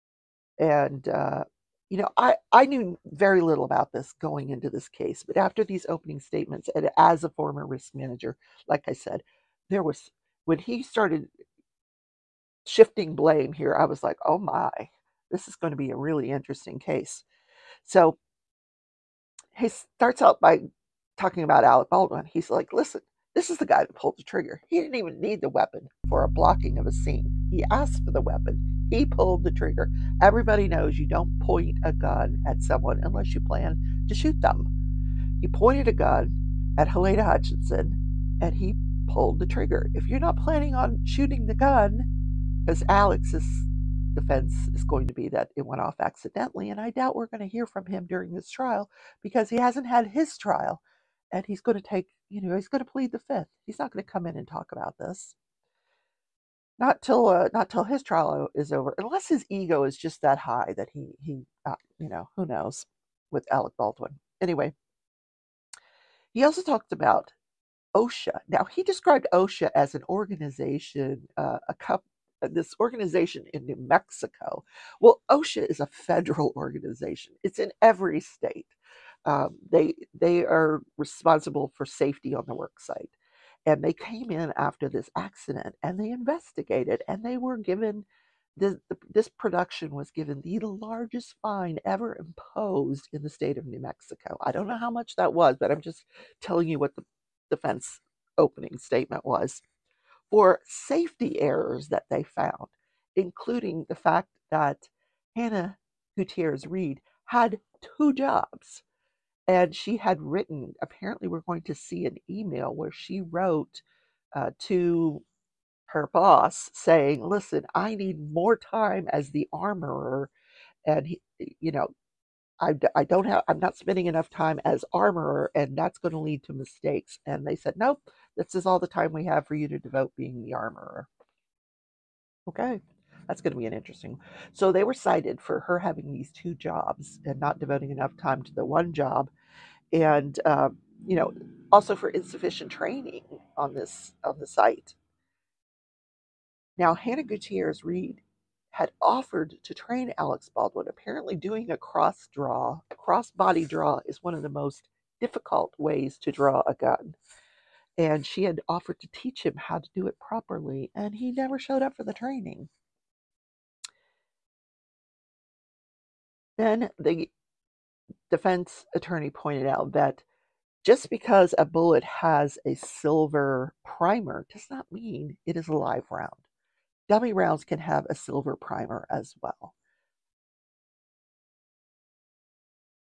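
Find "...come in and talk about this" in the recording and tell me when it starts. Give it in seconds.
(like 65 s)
54 s.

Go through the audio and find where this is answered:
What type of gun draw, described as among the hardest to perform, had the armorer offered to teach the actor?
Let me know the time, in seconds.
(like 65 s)
152 s.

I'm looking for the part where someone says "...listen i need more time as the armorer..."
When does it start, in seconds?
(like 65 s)
117 s.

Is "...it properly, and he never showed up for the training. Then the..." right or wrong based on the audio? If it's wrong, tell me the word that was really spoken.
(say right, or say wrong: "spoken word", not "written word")
right.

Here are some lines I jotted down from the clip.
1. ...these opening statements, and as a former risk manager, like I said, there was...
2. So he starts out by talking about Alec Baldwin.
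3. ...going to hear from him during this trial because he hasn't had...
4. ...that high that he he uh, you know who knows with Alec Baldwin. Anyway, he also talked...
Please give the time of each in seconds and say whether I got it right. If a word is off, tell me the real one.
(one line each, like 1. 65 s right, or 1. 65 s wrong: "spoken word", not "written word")
1. 5 s right
2. 17 s right
3. 47 s right
4. 60 s right.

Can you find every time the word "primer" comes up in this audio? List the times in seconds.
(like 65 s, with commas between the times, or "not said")
173 s, 178 s.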